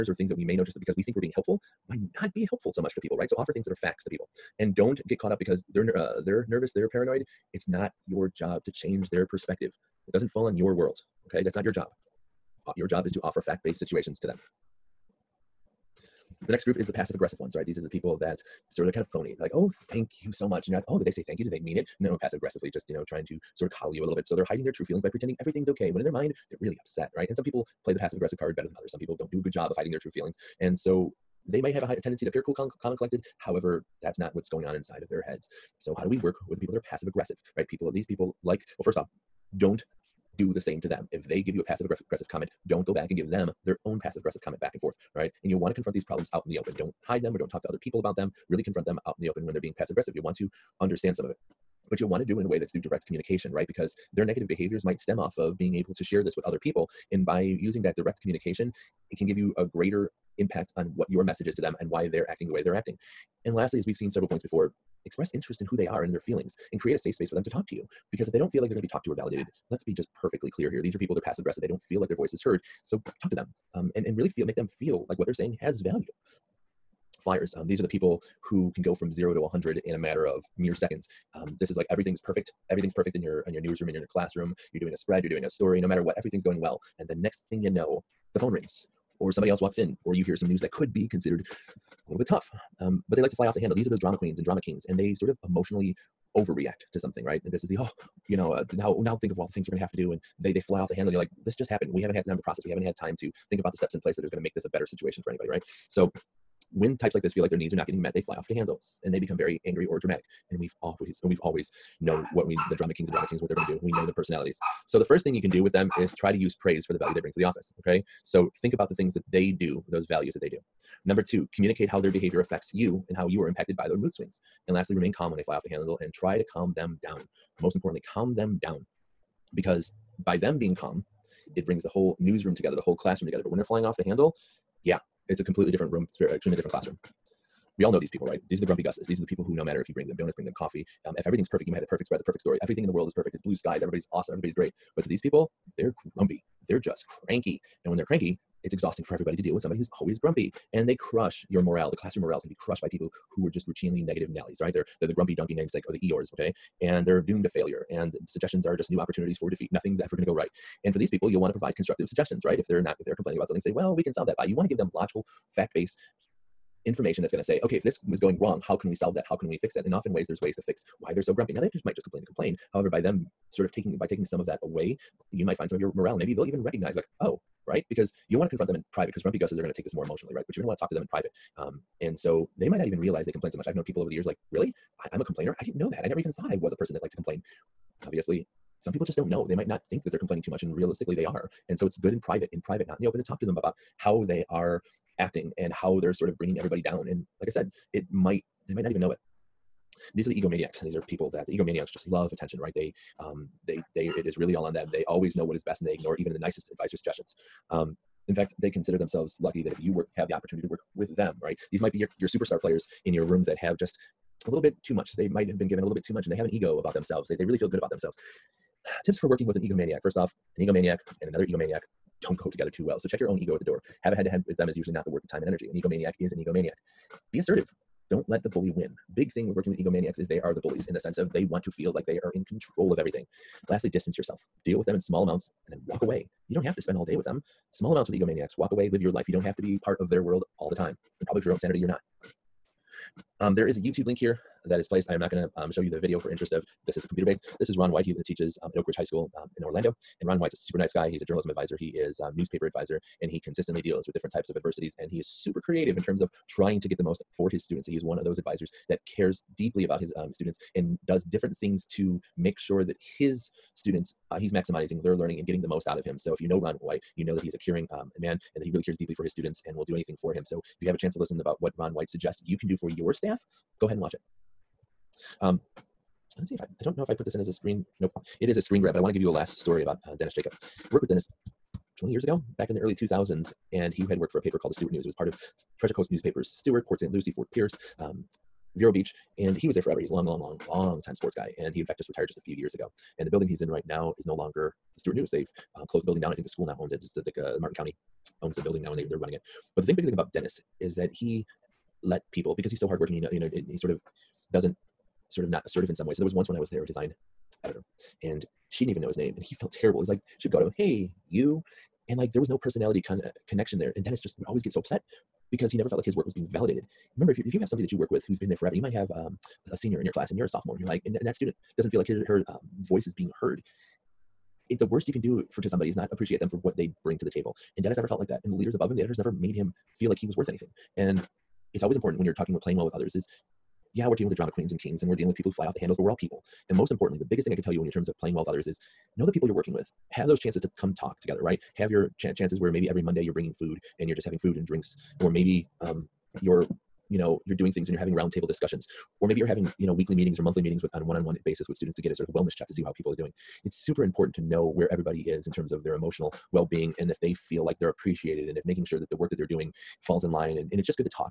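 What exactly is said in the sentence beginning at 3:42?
So check your own ego at the door.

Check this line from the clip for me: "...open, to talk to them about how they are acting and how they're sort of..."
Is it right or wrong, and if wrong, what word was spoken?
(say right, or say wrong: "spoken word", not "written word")
right.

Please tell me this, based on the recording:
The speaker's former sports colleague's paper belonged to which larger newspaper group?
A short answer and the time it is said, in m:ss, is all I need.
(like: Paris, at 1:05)
Treasure Coast newspapers, at 4:45.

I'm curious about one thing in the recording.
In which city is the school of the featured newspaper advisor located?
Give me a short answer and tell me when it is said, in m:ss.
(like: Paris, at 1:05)
Orlando, at 4:09.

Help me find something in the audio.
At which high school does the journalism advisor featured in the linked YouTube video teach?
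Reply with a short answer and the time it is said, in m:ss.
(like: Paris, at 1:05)
Oak Ridge High School, at 4:08.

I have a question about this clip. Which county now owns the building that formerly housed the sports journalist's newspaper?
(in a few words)
Martin County.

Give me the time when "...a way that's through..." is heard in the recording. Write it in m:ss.
0:52.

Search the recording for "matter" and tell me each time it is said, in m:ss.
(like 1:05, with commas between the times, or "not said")
1:19, 1:25, 2:19.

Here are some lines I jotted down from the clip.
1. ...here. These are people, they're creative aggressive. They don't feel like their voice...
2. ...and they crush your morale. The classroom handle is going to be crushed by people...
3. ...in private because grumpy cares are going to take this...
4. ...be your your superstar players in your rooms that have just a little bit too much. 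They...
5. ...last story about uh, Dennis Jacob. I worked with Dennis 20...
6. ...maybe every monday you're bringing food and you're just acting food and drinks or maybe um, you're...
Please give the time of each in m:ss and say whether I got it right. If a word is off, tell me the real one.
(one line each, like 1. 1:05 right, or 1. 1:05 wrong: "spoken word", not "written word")
1. 1:10 wrong: "passive", not "creative"
2. 2:30 wrong: "morale", not "handle"
3. 2:58 wrong: "gusses", not "cares"
4. 3:31 right
5. 4:39 right
6. 5:42 wrong: "having", not "acting".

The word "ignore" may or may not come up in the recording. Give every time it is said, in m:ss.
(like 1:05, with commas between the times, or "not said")
3:25.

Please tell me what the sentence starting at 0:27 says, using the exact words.
And some people play the passive aggressive card better than others.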